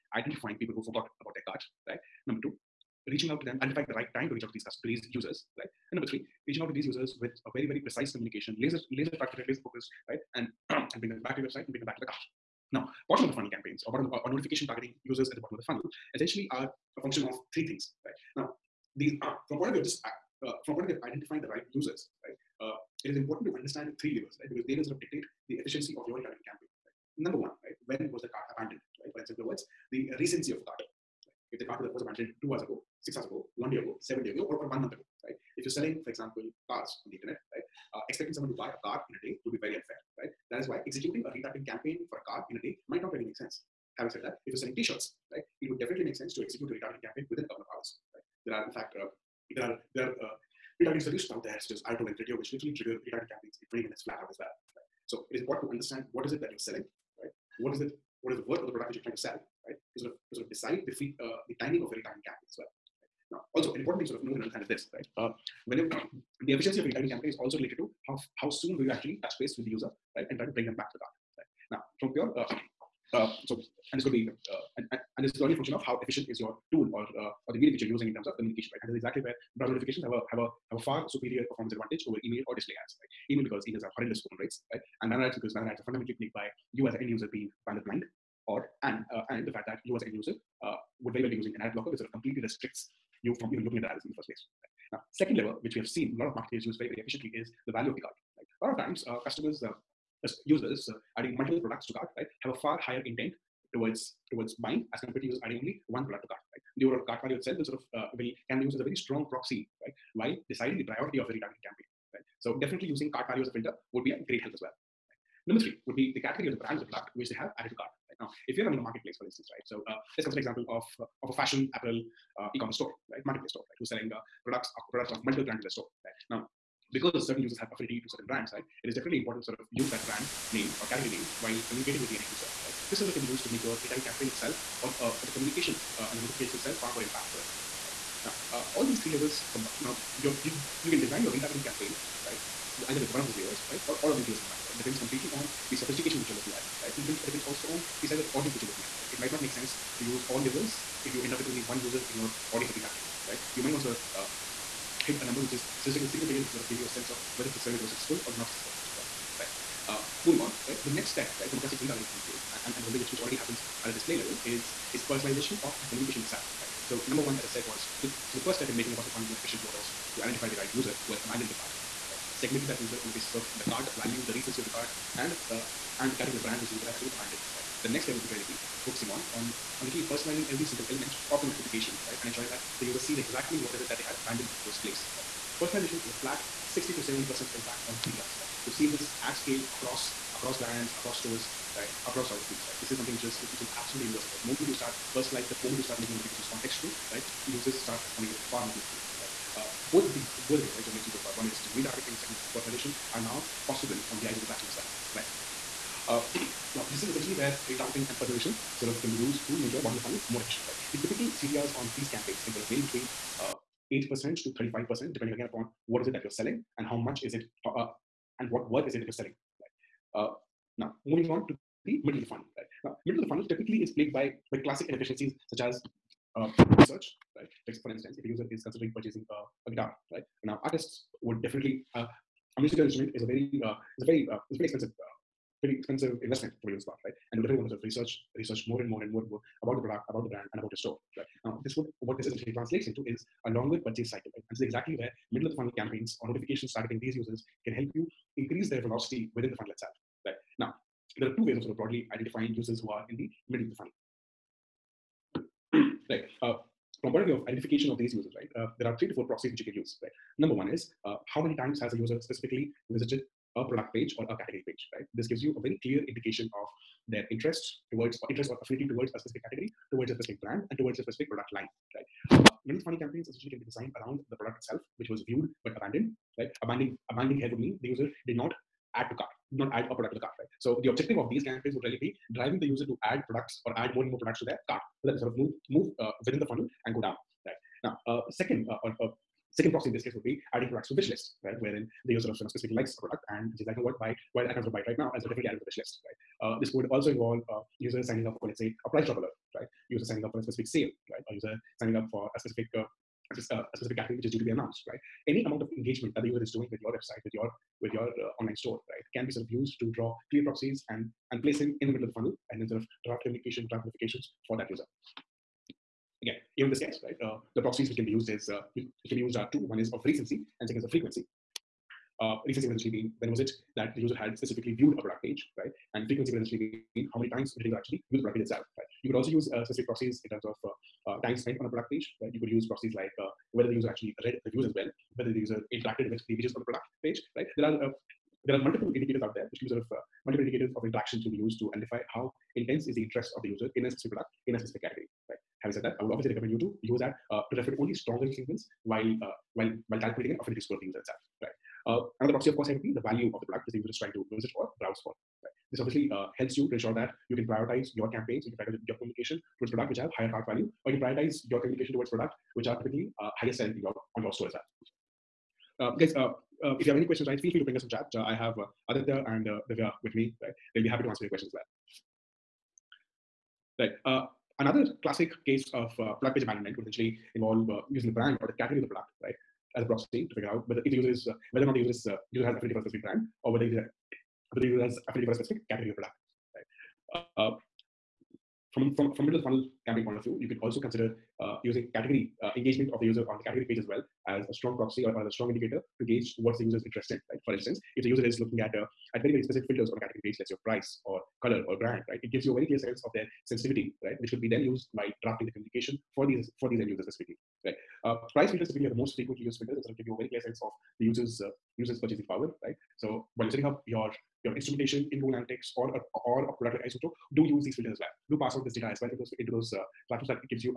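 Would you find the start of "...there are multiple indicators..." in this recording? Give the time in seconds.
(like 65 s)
338 s.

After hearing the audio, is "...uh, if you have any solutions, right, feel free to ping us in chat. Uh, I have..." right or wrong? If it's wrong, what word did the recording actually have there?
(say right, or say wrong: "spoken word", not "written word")
wrong: "questions", not "solutions".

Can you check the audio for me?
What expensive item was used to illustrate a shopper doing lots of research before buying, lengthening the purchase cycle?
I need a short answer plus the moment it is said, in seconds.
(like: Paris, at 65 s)
a guitar, at 229 s.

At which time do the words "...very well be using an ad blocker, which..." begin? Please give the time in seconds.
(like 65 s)
91 s.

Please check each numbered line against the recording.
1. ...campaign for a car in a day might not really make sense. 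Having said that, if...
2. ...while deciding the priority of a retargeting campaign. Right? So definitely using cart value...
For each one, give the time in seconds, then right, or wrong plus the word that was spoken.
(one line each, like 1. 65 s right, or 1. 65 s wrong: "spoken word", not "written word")
1. 41 s right
2. 110 s right.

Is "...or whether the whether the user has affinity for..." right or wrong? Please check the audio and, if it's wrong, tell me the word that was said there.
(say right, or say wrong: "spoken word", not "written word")
right.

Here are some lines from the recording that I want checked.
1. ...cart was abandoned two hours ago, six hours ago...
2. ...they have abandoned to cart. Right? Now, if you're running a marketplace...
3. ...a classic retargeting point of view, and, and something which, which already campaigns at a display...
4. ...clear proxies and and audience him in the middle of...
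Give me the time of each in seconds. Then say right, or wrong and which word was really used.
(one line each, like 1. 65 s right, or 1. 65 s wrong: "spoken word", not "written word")
1. 31 s right
2. 117 s wrong: "added", not "abandoned"
3. 161 s wrong: "happens", not "campaigns"
4. 310 s wrong: "place", not "audience".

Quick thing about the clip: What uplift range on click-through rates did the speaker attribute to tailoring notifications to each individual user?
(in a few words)
60 to 70%.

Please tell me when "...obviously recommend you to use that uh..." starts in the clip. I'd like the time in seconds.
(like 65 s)
346 s.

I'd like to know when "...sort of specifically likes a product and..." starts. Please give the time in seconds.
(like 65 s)
292 s.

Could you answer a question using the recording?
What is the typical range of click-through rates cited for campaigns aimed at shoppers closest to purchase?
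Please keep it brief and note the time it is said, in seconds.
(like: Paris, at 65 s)
8% to 35%, at 213 s.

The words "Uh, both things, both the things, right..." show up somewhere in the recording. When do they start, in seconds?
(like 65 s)
199 s.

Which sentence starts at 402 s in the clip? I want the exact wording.
It gives you a very clear sense of their sensitivity right?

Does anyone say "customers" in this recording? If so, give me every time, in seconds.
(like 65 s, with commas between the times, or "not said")
4 s, 99 s.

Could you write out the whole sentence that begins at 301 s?
A user signing up for a specific uh, a uh, specific category which is due to be announced, right?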